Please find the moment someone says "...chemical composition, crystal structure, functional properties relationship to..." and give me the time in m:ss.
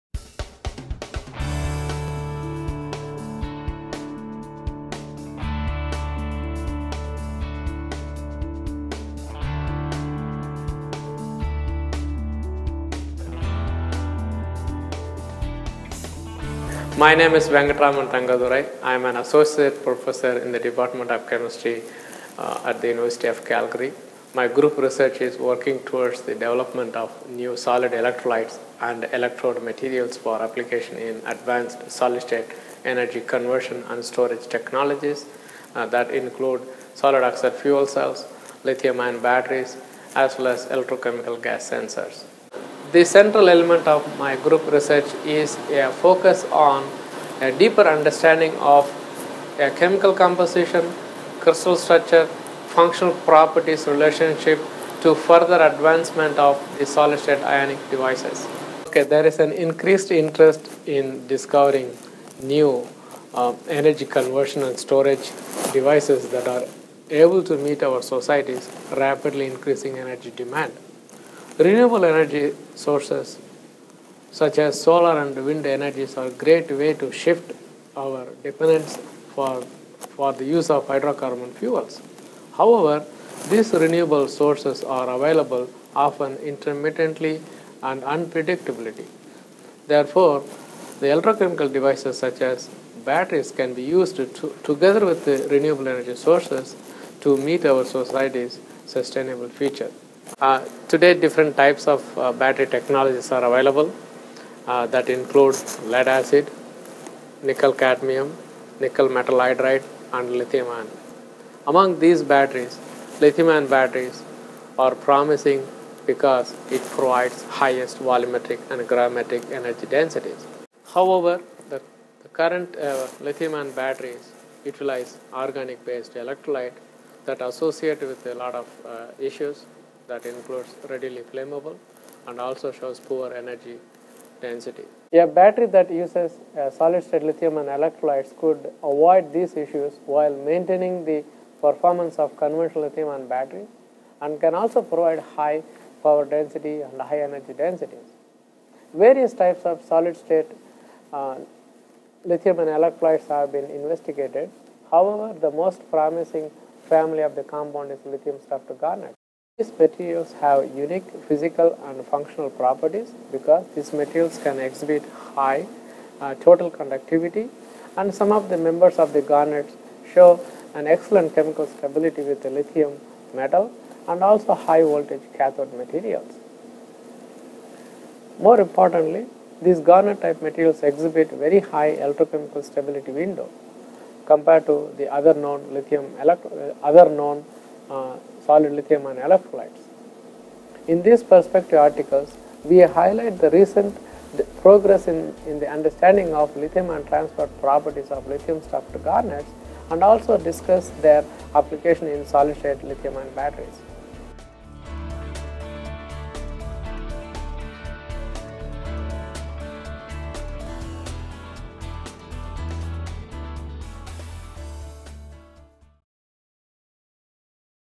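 0:49.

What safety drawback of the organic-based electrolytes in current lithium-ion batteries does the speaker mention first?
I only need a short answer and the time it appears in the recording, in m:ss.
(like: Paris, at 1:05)
readily flammable, at 2:10.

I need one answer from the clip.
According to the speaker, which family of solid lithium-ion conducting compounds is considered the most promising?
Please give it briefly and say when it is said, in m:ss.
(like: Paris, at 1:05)
lithium garnet, at 2:38.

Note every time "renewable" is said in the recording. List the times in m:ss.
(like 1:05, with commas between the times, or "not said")
1:11, 1:23, 1:35.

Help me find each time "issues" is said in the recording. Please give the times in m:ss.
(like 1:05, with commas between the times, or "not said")
2:09, 2:19.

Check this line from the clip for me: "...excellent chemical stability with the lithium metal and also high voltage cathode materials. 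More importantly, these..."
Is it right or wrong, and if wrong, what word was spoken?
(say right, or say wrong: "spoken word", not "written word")
right.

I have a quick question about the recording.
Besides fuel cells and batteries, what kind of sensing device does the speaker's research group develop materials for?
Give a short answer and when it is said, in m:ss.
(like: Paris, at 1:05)
electrochemical gas sensors, at 0:40.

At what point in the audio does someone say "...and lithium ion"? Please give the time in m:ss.
1:50.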